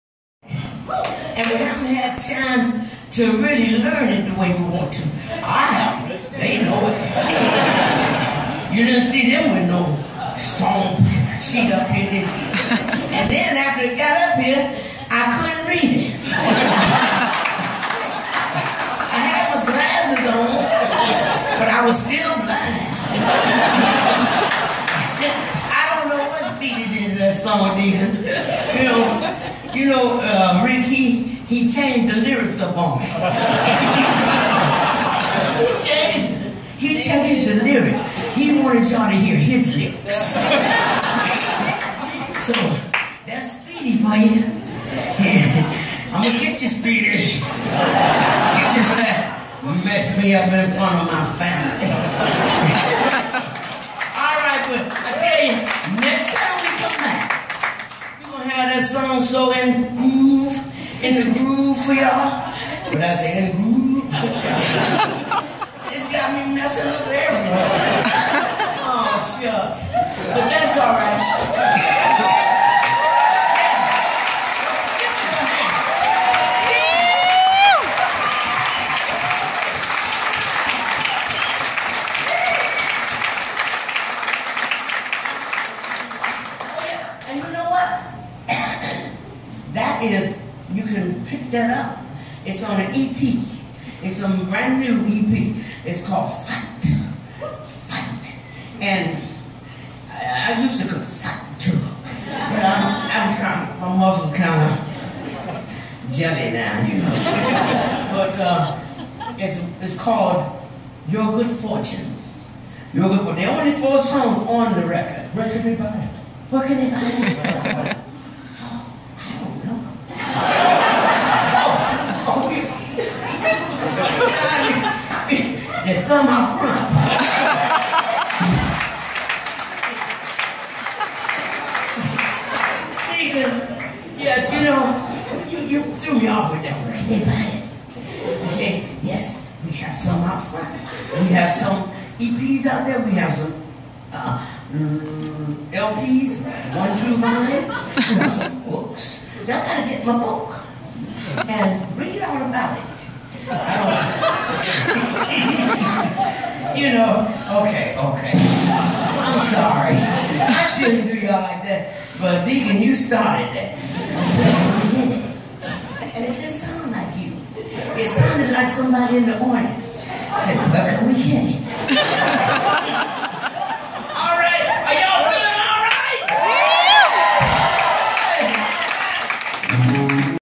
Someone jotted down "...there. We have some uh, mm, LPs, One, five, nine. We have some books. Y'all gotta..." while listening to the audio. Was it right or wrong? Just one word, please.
wrong.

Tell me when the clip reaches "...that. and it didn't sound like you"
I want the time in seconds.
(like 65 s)
163 s.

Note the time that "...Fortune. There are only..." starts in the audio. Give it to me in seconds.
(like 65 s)
113 s.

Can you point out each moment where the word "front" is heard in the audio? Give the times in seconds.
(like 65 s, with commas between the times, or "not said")
50 s, 126 s, 140 s.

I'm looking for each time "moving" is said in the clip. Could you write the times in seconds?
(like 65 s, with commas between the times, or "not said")
not said.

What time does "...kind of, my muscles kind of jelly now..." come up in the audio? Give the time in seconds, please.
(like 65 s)
103 s.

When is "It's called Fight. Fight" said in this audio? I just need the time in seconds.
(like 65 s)
95 s.